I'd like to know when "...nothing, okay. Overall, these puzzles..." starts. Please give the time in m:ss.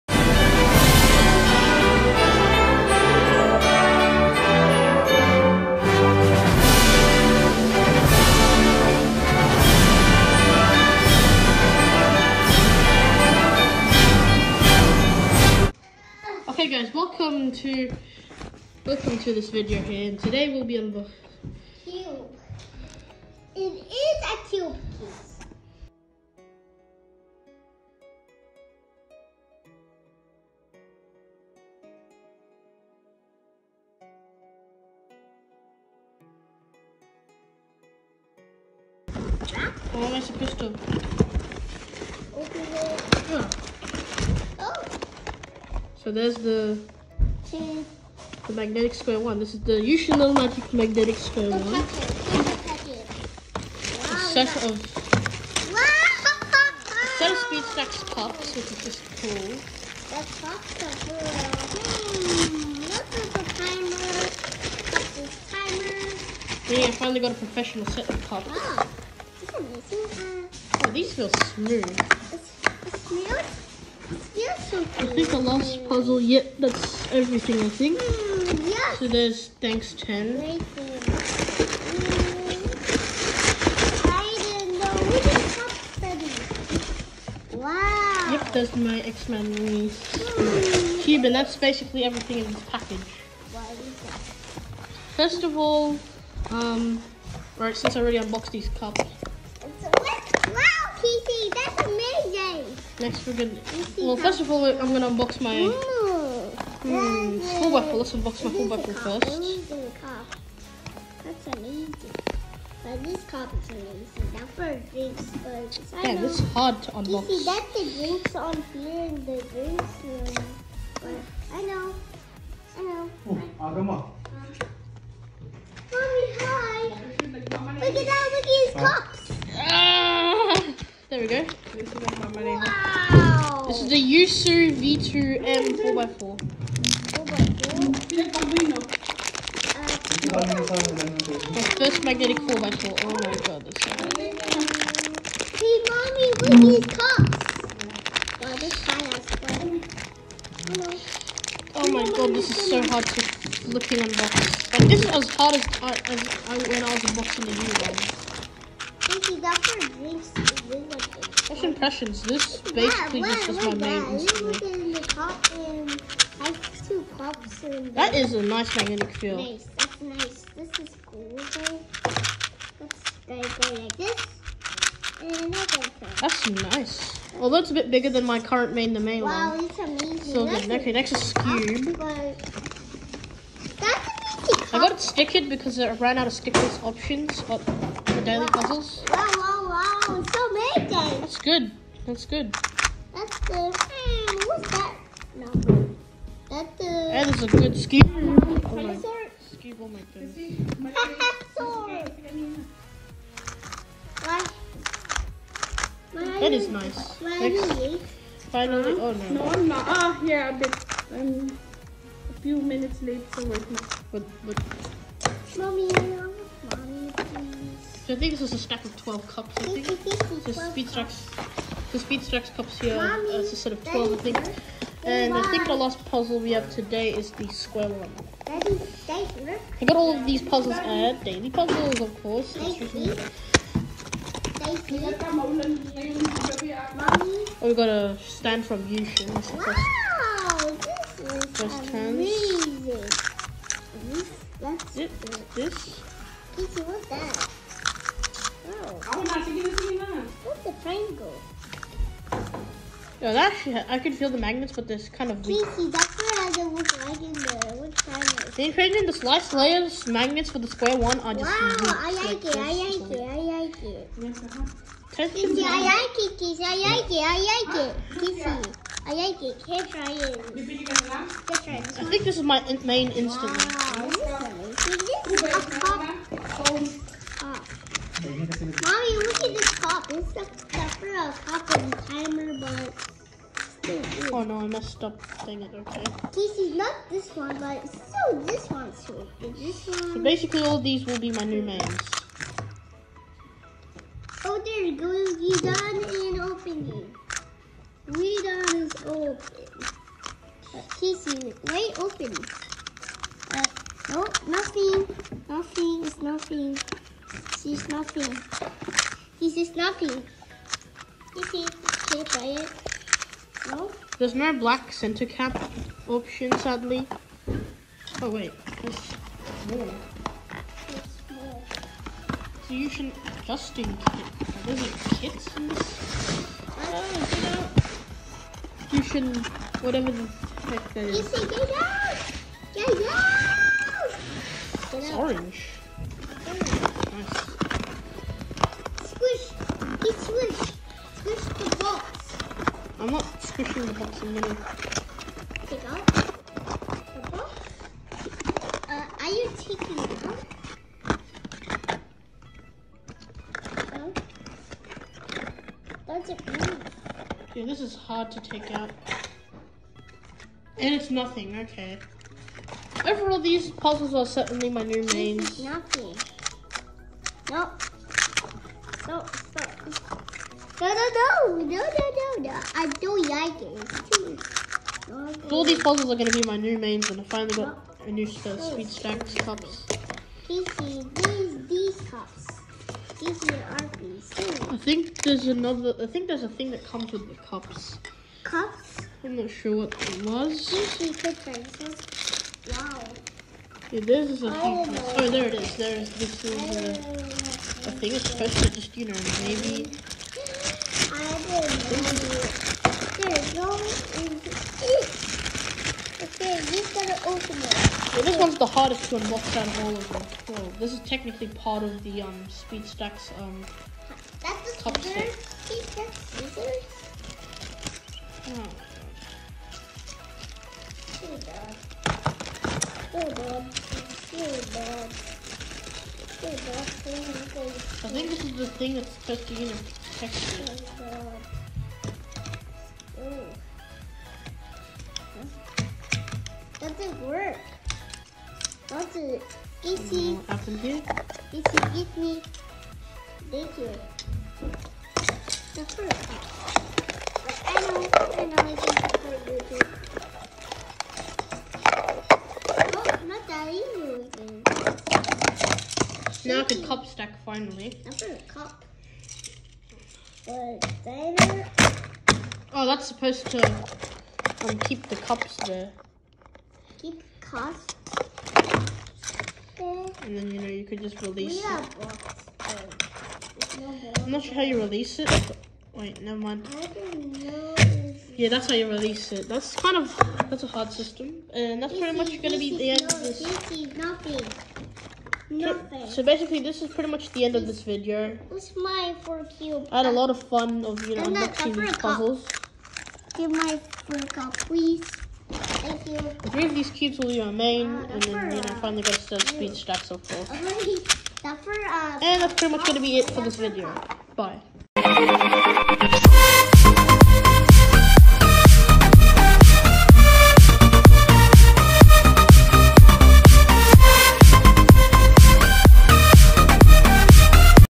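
6:01.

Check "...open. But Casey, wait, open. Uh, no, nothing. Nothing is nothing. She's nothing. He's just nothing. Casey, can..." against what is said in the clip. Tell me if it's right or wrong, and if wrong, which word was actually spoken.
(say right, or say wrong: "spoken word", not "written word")
right.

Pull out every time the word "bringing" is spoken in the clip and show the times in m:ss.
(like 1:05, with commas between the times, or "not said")
not said.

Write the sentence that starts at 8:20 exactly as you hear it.
Uh, and that's pretty much going to be it for this video.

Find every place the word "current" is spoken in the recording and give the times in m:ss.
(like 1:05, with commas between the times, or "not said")
2:58.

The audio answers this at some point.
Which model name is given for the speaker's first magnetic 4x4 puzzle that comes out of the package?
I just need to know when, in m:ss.
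2:14.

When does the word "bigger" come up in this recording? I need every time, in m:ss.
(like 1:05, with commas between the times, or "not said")
2:57.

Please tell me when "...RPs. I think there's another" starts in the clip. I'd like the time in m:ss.
6:23.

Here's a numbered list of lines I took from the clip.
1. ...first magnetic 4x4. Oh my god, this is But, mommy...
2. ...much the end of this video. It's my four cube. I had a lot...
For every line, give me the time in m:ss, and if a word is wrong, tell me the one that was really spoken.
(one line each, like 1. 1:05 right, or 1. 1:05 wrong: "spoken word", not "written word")
1. 2:21 wrong: "Hey", not "But"
2. 8:07 right.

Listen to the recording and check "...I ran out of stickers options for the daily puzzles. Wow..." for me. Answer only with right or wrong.
right.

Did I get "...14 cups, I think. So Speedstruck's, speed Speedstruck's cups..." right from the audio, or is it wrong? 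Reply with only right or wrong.
wrong.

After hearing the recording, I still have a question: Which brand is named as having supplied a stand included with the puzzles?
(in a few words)
YuXin.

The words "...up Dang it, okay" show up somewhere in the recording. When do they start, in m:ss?
4:45.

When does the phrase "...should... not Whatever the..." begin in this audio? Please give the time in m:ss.
5:29.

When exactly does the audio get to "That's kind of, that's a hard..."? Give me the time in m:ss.
7:59.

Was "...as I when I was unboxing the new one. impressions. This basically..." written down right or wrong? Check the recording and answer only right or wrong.
right.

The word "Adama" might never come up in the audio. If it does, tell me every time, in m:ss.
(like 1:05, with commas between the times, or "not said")
2:03.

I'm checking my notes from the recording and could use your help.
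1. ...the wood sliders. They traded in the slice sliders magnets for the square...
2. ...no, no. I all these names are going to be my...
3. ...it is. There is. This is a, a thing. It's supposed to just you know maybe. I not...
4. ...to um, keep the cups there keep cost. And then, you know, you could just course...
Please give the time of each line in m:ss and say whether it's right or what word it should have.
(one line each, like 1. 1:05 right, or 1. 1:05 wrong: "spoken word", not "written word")
1. 4:17 wrong: "layers", not "sliders"
2. 6:11 wrong: "puzzles", not "names"
3. 6:35 right
4. 7:43 wrong: "release", not "course".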